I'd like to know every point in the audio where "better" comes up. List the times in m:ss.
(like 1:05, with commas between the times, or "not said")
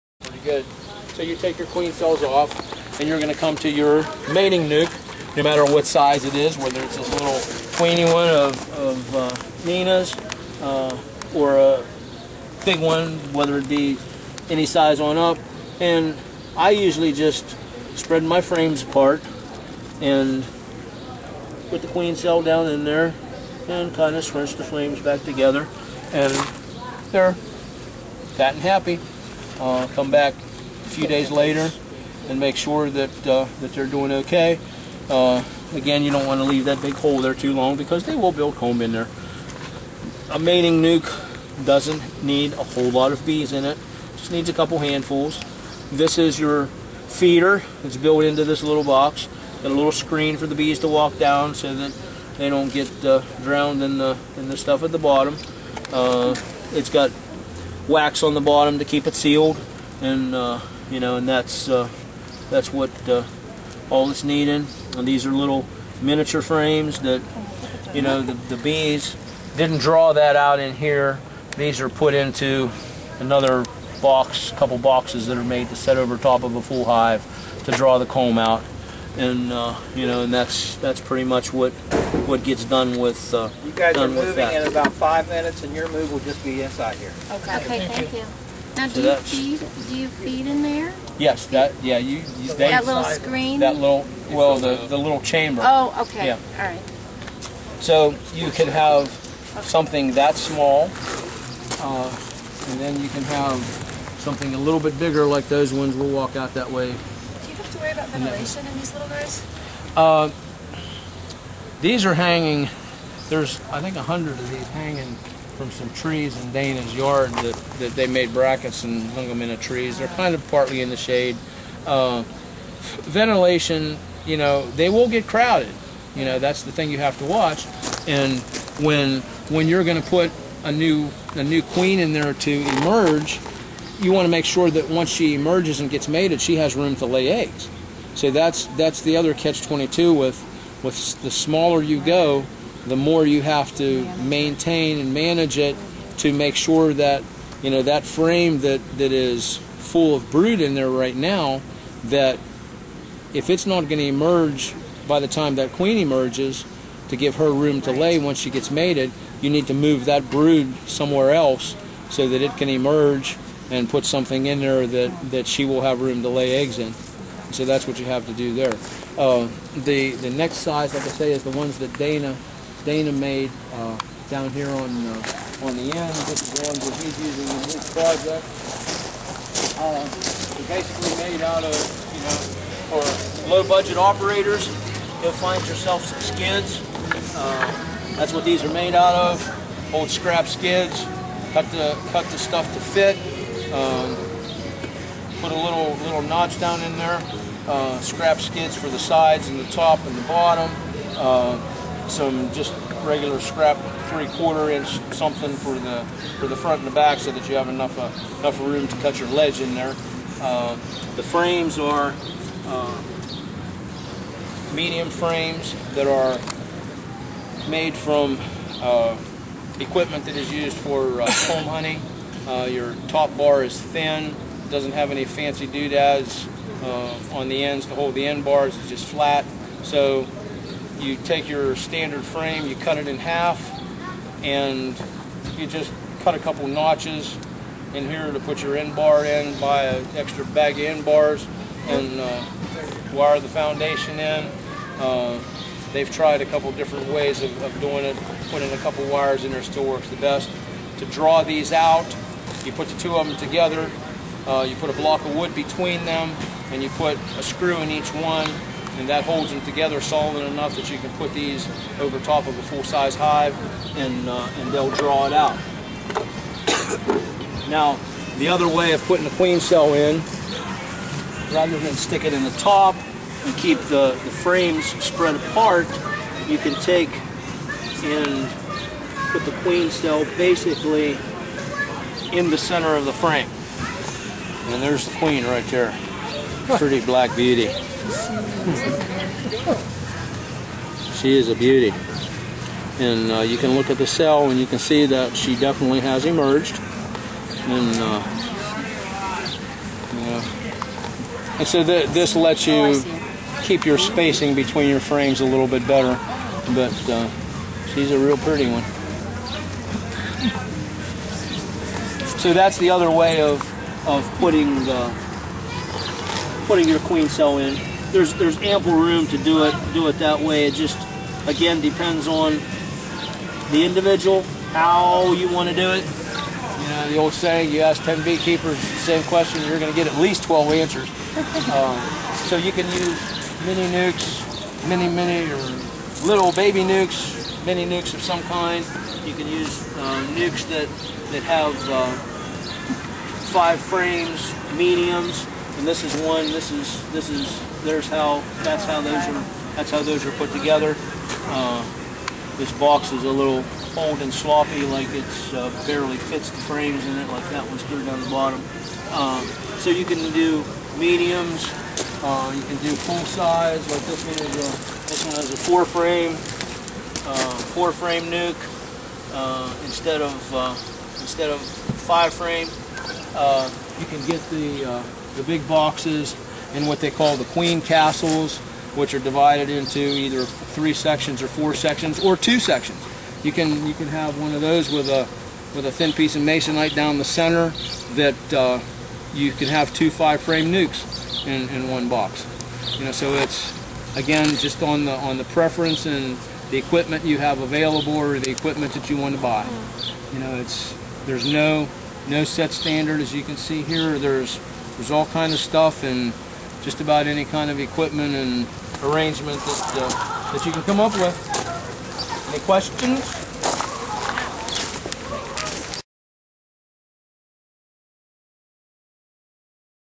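5:05.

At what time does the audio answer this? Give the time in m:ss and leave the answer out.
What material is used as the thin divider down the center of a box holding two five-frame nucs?
6:26.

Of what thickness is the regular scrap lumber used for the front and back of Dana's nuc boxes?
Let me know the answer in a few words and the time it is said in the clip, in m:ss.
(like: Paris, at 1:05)
Three-quarter inch, at 3:24.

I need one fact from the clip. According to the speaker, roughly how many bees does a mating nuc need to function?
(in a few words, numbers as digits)
A couple handfuls.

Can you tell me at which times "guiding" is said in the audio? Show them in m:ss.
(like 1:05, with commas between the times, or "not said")
not said.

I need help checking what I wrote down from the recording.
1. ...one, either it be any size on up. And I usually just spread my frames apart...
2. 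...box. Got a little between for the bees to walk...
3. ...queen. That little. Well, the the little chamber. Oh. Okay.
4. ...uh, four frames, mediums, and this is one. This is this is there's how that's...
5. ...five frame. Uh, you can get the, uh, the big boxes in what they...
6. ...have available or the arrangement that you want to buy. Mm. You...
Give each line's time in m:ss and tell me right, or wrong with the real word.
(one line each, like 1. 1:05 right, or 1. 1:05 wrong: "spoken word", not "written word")
1. 0:12 wrong: "whether", not "either"
2. 0:48 wrong: "screen", not "between"
3. 1:33 wrong: "screen", not "queen"
4. 5:41 wrong: "five", not "four"
5. 6:11 right
6. 6:37 wrong: "equipment", not "arrangement".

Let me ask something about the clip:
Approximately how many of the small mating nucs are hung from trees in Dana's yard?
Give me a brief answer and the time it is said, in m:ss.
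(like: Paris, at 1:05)
100, at 1:53.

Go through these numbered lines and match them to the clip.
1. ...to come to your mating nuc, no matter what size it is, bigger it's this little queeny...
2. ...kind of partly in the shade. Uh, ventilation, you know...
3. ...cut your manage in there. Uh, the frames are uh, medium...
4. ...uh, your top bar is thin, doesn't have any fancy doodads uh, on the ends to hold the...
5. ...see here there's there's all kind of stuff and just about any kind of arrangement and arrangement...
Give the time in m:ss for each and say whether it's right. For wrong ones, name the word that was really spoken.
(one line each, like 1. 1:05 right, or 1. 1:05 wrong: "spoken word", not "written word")
1. 0:03 wrong: "whether", not "bigger"
2. 2:00 right
3. 3:28 wrong: "ledge", not "manage"
4. 3:42 right
5. 6:43 wrong: "equipment", not "arrangement".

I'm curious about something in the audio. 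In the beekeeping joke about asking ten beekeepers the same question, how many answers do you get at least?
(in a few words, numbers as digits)
12.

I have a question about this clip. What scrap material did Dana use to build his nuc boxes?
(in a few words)
Old scrap skids.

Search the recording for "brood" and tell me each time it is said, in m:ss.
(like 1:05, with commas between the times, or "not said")
2:30, 2:40.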